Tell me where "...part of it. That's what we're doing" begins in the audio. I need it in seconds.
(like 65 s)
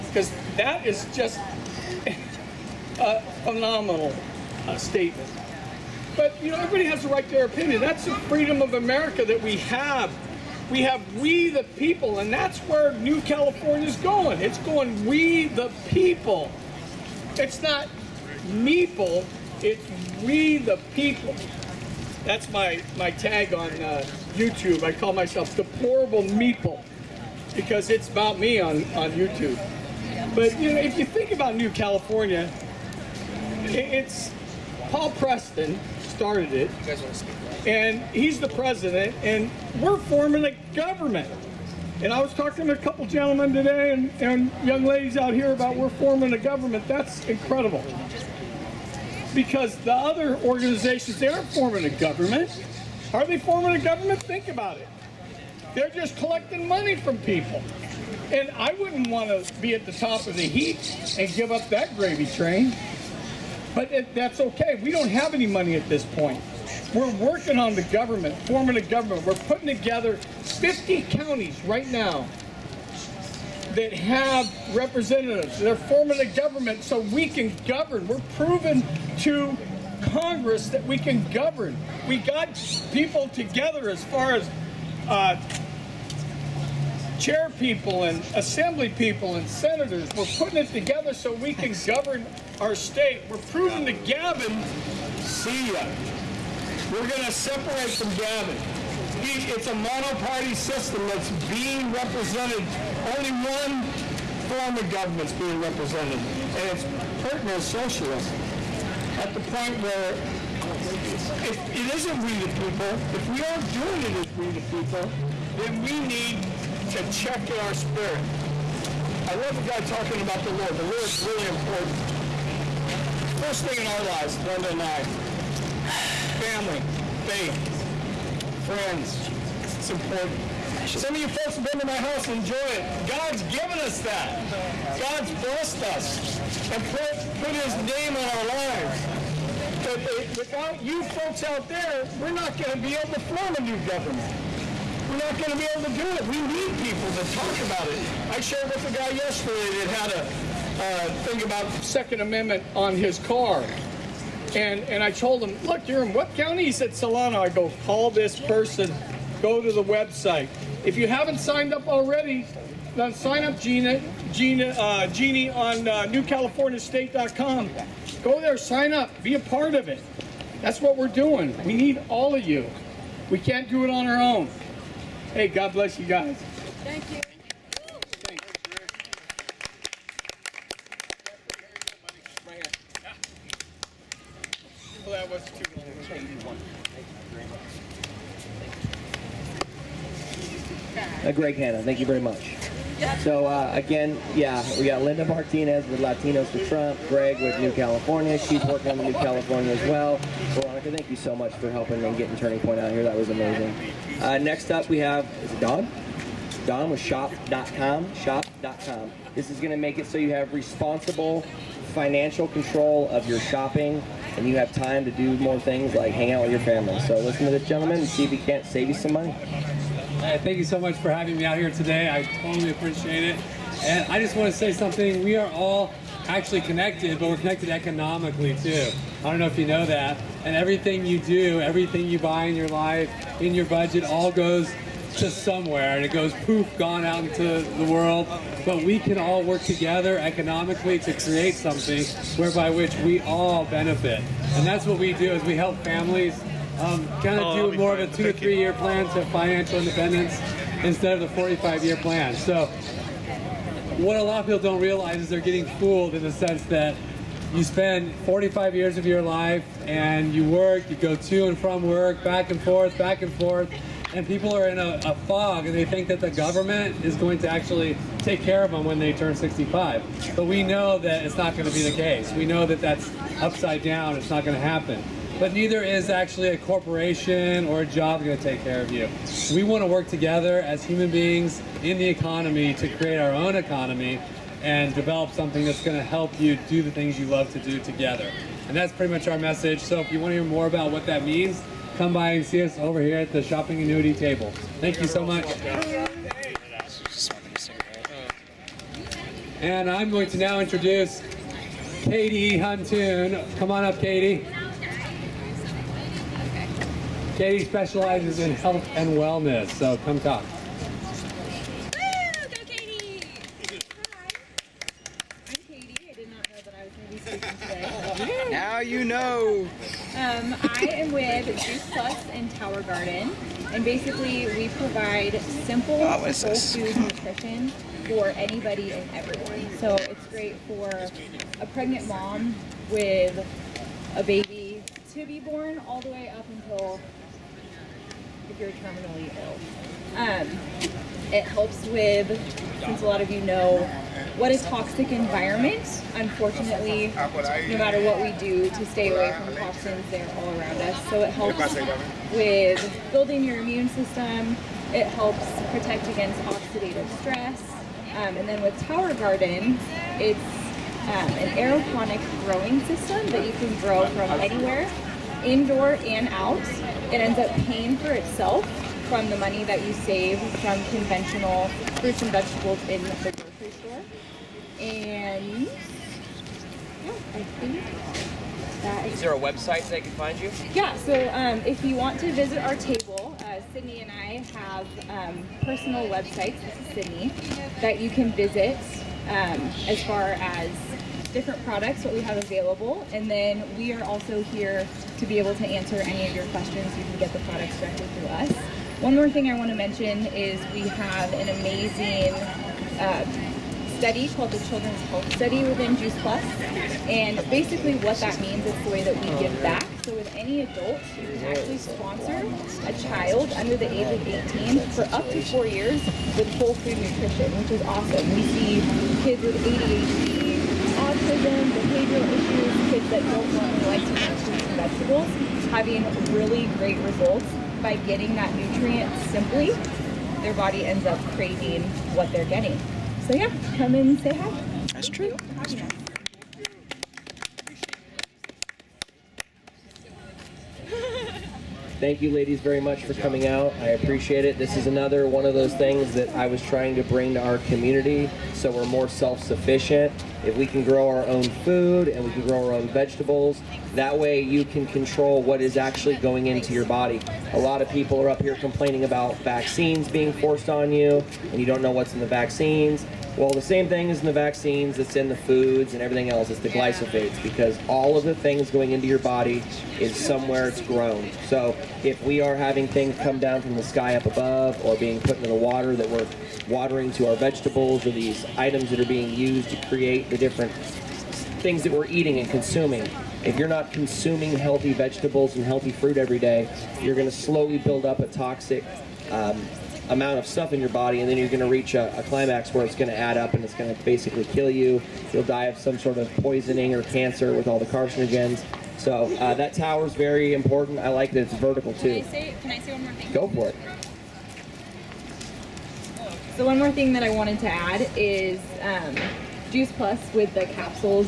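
169 s.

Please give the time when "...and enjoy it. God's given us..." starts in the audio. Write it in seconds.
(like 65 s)
132 s.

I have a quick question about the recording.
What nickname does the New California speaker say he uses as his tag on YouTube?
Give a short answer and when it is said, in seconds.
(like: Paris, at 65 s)
Deplorable Meeple, at 25 s.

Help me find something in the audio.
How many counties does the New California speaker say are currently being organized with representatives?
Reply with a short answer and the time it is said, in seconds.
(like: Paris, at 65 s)
50, at 70 s.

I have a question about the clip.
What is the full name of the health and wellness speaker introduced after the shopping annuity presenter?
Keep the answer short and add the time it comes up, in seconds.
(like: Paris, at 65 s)
Katie Huntoon, at 302 s.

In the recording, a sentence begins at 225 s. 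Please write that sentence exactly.
We are all actually connected, but we're connected economically too.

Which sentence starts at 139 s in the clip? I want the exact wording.
But it, without you folks out there, we're not going to be able to form a new government.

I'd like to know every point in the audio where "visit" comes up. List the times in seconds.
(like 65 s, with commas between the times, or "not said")
382 s, 388 s.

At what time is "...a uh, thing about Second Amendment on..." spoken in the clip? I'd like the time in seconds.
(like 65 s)
150 s.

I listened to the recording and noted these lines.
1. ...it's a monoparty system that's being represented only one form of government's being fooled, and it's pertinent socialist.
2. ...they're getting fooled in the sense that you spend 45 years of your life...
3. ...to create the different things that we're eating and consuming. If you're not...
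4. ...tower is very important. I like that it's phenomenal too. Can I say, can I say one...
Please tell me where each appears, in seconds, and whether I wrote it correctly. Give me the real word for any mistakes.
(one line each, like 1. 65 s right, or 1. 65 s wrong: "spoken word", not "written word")
1. 99 s wrong: "represented", not "fooled"
2. 255 s right
3. 479 s right
4. 499 s wrong: "vertical", not "phenomenal".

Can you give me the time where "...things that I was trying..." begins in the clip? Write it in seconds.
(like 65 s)
445 s.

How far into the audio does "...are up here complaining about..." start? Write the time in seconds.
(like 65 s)
458 s.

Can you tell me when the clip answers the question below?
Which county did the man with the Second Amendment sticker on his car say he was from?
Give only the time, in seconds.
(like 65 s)
156 s.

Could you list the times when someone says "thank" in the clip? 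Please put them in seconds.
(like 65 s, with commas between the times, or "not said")
176 s, 191 s, 200 s, 220 s, 294 s, 441 s.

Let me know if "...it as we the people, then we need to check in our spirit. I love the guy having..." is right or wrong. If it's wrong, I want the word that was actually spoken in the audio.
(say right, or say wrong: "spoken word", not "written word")
wrong: "talking", not "having".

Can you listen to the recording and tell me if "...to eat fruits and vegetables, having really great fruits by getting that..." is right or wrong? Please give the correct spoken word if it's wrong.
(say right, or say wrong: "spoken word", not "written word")
wrong: "results", not "fruits".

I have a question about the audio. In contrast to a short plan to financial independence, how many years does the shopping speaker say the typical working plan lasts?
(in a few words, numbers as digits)
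45.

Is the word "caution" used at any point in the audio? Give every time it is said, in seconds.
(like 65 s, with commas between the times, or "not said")
not said.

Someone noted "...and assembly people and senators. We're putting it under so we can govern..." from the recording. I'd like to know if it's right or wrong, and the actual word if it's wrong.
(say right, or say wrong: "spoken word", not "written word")
wrong: "together", not "under".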